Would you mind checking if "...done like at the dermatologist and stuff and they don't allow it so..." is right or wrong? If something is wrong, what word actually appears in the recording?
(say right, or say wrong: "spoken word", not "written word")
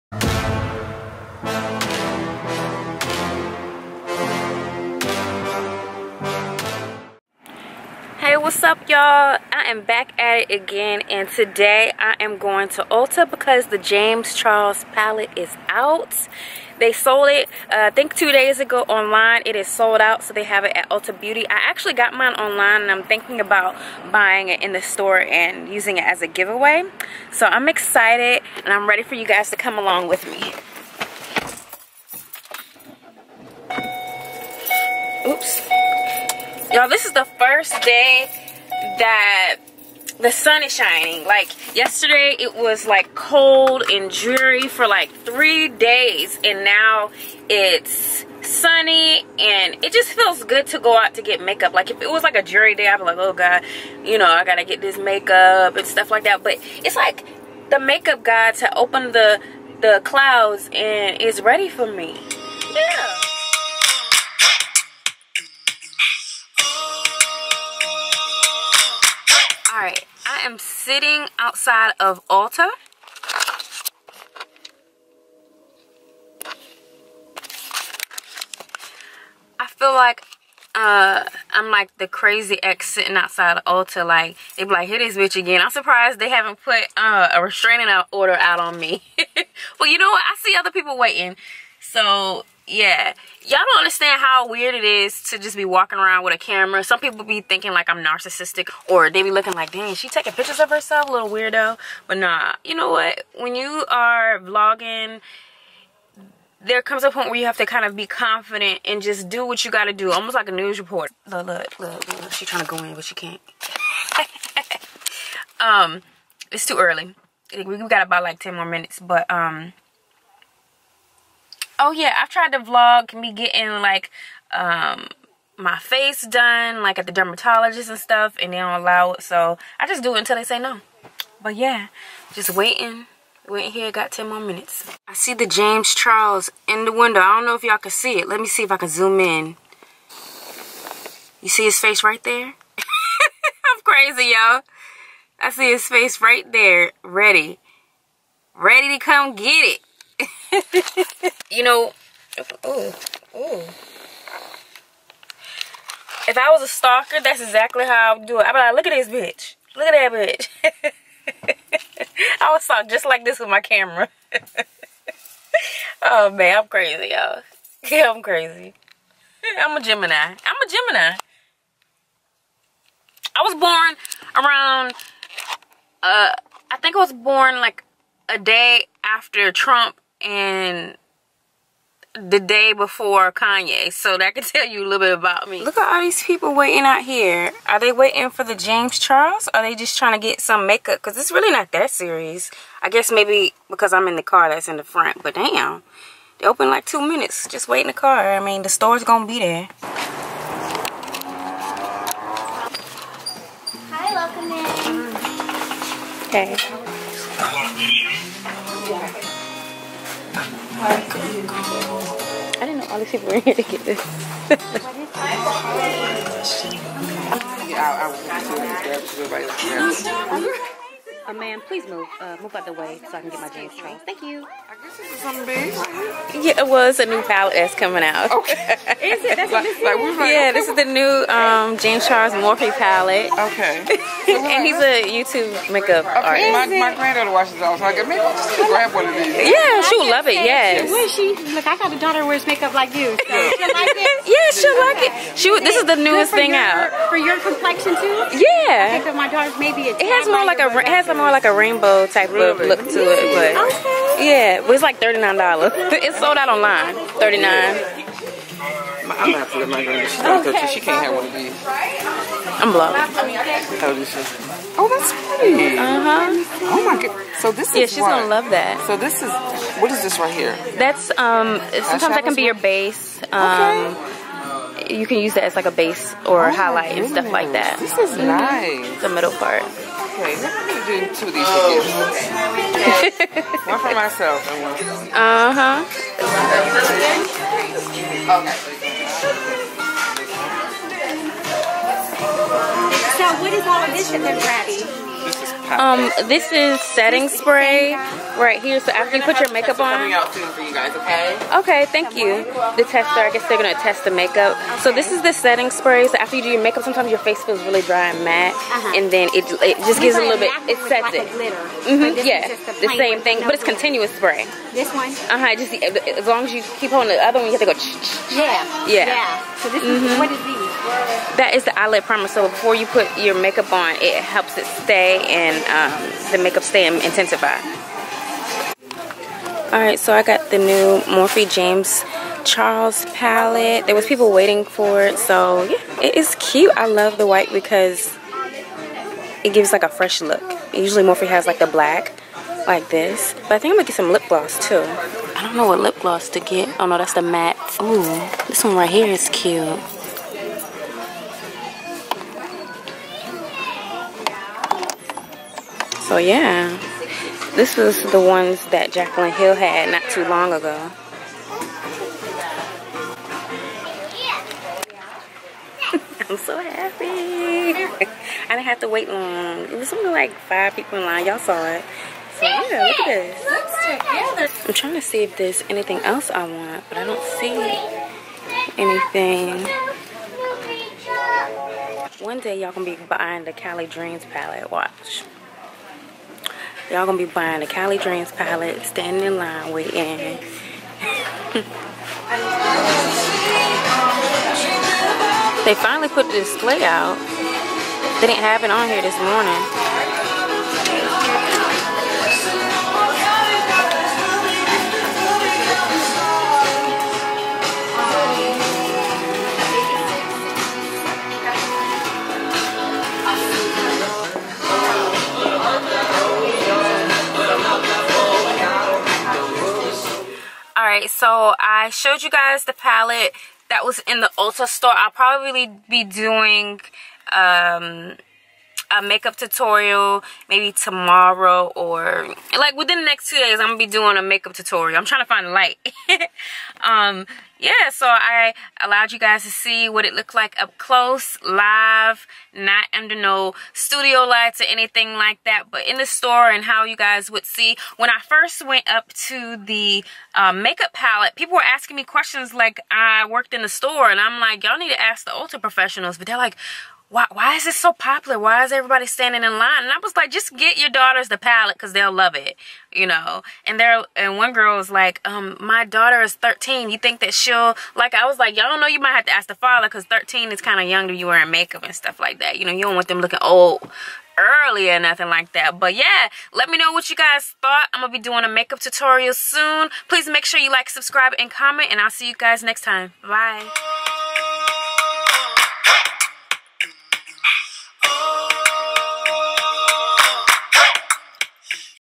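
right.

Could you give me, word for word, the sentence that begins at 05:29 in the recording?
Alright, so I got the new Morphe James Charles palette.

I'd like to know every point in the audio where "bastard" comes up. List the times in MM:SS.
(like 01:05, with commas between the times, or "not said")
not said.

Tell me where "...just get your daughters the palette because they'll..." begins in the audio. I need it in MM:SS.
07:40.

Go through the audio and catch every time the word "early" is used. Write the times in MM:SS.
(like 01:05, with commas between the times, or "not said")
01:56, 07:54.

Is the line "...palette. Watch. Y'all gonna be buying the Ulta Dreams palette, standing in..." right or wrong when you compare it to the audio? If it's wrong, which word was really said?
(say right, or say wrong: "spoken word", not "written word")
wrong: "Kalee", not "Ulta".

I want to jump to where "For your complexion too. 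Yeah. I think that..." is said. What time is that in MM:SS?
04:07.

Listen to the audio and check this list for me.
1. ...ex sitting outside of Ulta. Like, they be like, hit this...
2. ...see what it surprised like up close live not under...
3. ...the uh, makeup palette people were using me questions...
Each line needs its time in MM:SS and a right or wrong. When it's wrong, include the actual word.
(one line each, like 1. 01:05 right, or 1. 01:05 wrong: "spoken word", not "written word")
1. 01:22 right
2. 07:19 wrong: "looked", not "surprised"
3. 07:29 wrong: "asking", not "using".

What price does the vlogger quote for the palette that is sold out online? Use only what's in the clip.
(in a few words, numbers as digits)
$39.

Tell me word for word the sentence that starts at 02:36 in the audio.
If I was a stalker, that's exactly how I would do it.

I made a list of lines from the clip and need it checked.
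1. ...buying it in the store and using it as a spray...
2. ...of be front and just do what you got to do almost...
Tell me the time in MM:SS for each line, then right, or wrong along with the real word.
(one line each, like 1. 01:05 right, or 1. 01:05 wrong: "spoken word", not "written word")
1. 00:24 wrong: "giveaway", not "spray"
2. 01:47 wrong: "confident", not "front".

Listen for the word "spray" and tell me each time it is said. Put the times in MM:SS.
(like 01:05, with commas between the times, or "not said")
04:57, 05:05, 05:14.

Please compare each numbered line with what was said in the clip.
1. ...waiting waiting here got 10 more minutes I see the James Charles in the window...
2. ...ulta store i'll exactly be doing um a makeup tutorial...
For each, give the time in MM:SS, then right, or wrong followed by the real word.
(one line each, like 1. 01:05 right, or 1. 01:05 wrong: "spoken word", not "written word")
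1. 02:12 right
2. 07:04 wrong: "probably", not "exactly".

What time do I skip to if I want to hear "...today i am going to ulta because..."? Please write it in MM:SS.
00:11.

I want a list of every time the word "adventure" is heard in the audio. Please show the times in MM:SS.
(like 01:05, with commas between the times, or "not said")
not said.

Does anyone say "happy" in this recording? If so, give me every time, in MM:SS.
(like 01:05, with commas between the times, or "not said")
06:06.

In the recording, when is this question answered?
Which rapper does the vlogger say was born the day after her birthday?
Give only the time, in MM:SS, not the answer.
03:03.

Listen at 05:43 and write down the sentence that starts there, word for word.
But I think I'm gonna get some lip gloss too.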